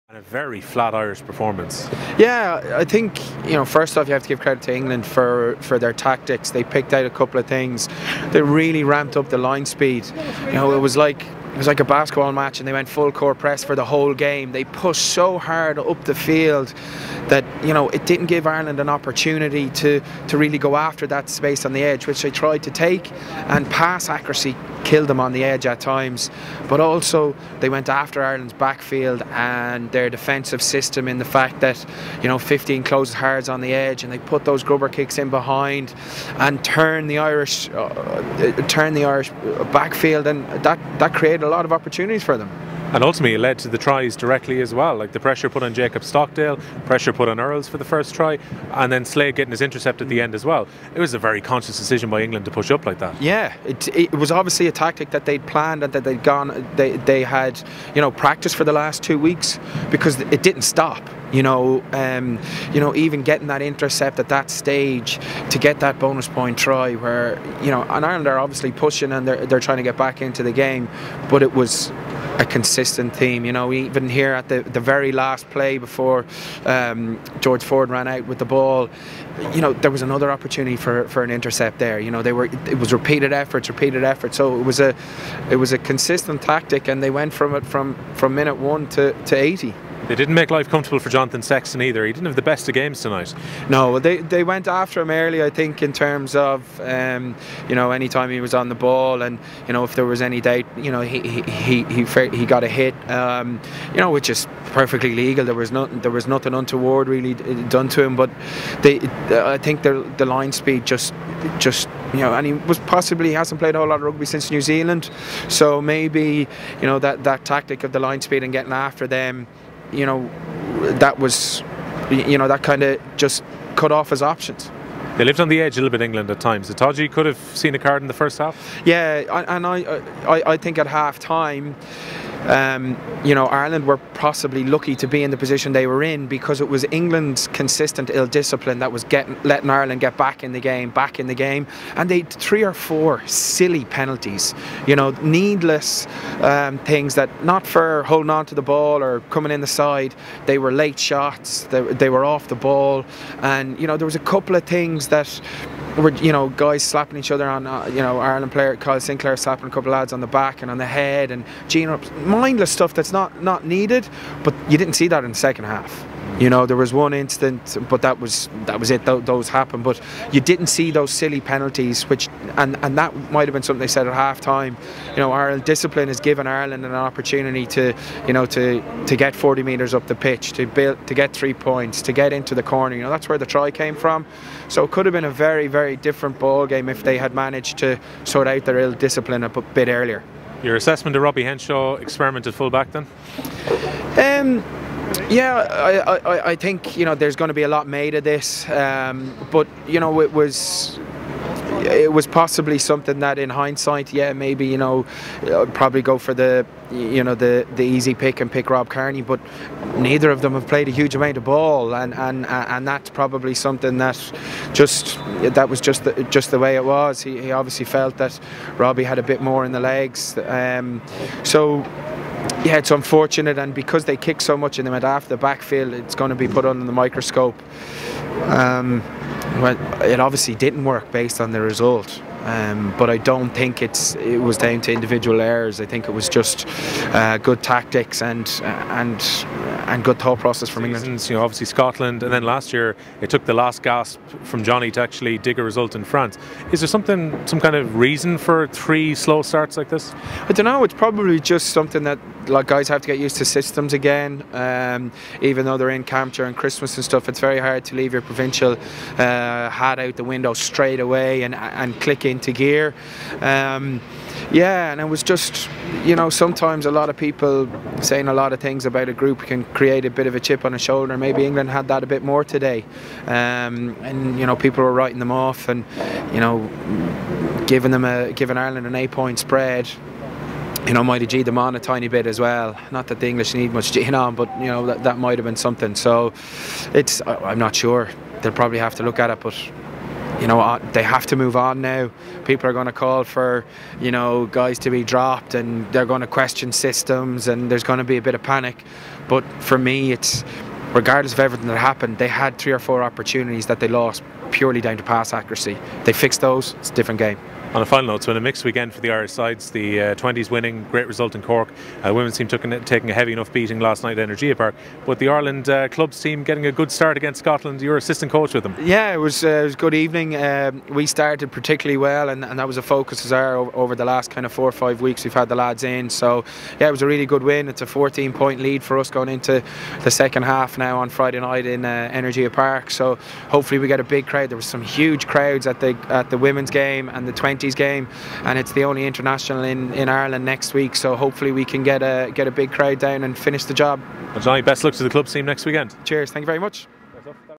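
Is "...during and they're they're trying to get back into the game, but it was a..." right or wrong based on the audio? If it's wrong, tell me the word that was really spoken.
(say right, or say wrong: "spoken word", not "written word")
wrong: "pushing", not "during".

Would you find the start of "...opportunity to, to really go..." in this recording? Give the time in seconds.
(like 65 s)
18 s.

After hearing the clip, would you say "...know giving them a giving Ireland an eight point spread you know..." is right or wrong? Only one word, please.
right.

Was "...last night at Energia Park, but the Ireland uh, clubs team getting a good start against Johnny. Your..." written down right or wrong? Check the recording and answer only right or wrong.
wrong.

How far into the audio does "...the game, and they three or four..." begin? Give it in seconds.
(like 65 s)
141 s.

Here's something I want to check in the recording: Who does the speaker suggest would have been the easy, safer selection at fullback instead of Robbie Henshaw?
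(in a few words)
Rob Kearney.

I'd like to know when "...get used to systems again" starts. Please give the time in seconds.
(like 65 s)
253 s.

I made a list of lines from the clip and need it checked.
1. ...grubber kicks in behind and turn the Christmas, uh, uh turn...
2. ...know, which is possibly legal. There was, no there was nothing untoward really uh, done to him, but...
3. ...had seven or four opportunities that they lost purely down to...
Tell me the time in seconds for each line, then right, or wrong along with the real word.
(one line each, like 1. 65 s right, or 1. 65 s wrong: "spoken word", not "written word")
1. 34 s wrong: "Irish", not "Christmas"
2. 103 s wrong: "perfectly", not "possibly"
3. 302 s wrong: "three", not "seven".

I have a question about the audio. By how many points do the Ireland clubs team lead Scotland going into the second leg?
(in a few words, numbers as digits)
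14.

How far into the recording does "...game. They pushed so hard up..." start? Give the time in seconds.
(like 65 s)
14 s.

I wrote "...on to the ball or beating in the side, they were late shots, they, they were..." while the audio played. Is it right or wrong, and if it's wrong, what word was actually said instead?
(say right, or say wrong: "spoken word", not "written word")
wrong: "coming", not "beating".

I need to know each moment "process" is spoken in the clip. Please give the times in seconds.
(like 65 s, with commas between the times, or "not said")
240 s.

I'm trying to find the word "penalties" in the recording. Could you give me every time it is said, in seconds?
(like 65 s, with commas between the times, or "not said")
143 s, 171 s.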